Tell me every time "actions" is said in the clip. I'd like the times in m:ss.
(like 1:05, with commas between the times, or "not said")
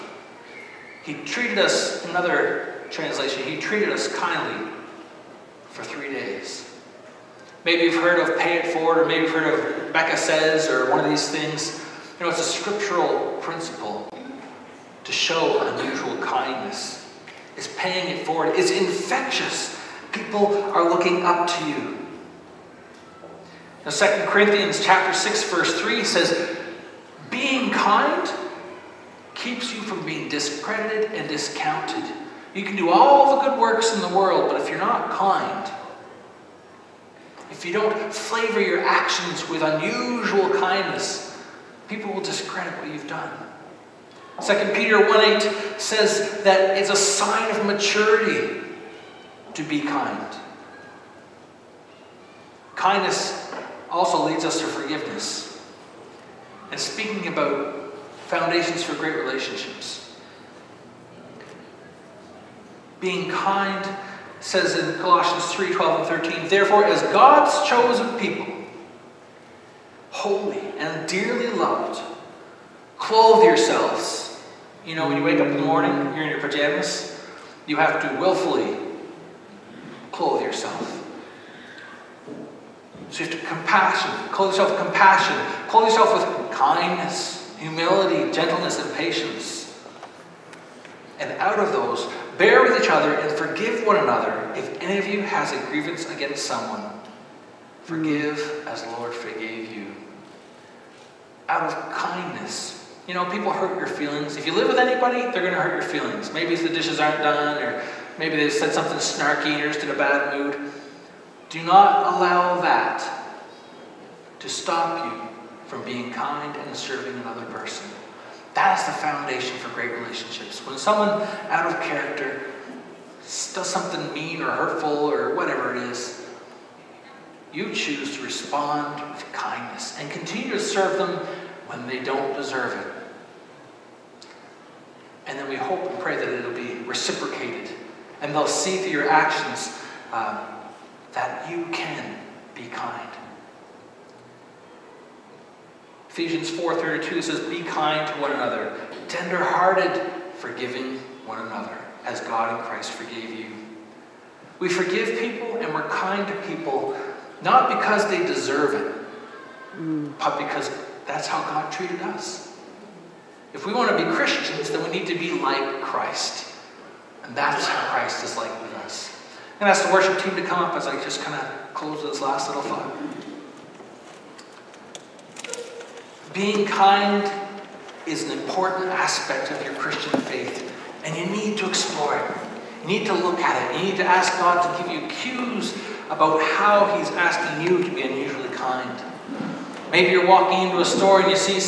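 0:38, 2:19.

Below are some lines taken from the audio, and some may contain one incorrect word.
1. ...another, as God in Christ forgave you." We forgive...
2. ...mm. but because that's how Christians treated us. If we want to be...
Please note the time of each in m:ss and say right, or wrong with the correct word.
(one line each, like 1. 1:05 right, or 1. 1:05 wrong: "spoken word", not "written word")
1. 2:31 right
2. 2:39 wrong: "God", not "Christians".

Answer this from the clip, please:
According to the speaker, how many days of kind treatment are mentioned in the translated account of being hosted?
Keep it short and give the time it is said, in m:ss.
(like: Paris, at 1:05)
3 days, at 0:05.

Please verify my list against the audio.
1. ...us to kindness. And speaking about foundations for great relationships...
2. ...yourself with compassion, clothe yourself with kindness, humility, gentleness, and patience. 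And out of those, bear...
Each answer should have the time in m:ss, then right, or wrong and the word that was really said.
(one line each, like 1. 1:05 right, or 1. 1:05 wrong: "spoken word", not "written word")
1. 0:54 wrong: "forgiveness", not "kindness"
2. 1:24 right.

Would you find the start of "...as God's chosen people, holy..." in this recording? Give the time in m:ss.
1:06.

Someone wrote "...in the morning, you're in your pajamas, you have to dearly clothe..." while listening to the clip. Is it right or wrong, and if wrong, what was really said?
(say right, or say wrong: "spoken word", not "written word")
wrong: "willfully", not "dearly".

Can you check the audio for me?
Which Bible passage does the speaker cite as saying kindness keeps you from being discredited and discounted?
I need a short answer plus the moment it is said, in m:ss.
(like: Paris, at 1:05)
2 Corinthians 6:3, at 0:23.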